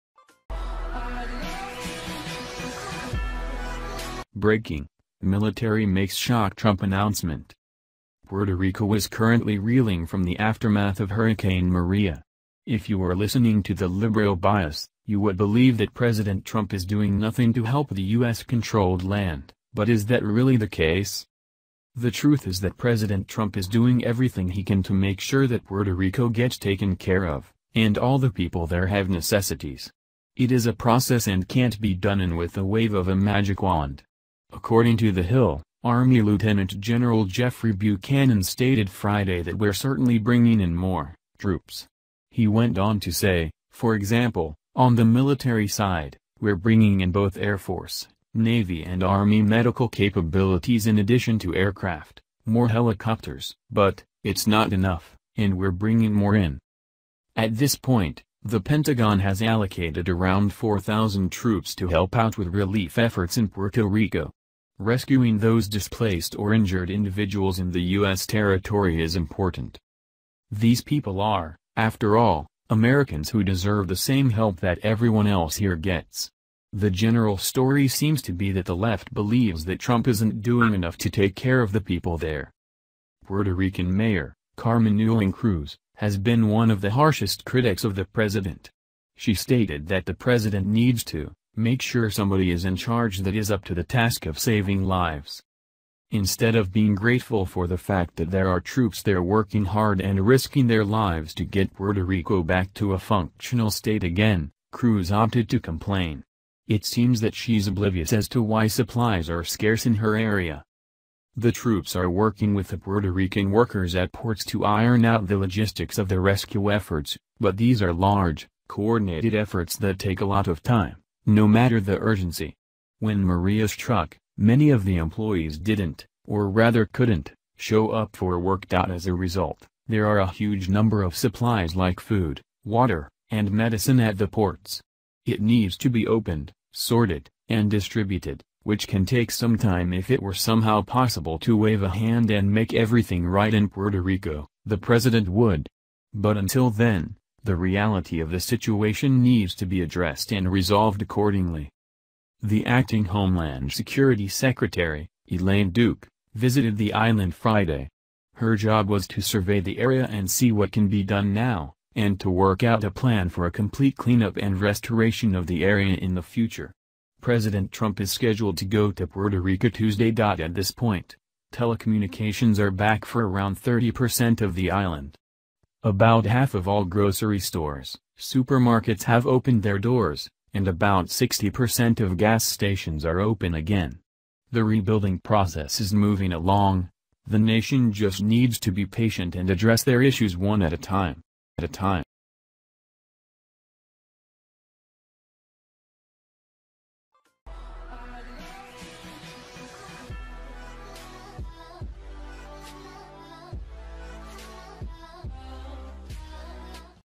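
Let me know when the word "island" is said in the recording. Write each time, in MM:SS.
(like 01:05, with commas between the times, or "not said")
02:36, 02:54.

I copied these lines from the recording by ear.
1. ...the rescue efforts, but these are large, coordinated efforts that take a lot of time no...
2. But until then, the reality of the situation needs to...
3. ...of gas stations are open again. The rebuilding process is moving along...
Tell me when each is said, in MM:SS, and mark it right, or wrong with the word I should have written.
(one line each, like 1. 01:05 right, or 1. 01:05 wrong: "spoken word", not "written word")
1. 01:56 right
2. 02:26 right
3. 03:01 right.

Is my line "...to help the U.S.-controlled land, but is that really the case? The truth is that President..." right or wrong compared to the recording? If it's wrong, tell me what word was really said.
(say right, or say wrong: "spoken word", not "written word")
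right.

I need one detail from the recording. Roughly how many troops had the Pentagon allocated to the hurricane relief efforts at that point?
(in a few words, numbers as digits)
4,000.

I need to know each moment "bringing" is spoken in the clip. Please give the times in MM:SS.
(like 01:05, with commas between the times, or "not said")
00:40, 00:46, 00:55.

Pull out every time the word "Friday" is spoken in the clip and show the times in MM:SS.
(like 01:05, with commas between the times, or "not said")
00:38, 02:37.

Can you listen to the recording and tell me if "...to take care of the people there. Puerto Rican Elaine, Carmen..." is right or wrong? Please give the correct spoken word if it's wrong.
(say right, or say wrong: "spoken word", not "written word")
wrong: "Mayor", not "Elaine".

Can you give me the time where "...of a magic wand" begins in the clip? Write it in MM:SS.
00:32.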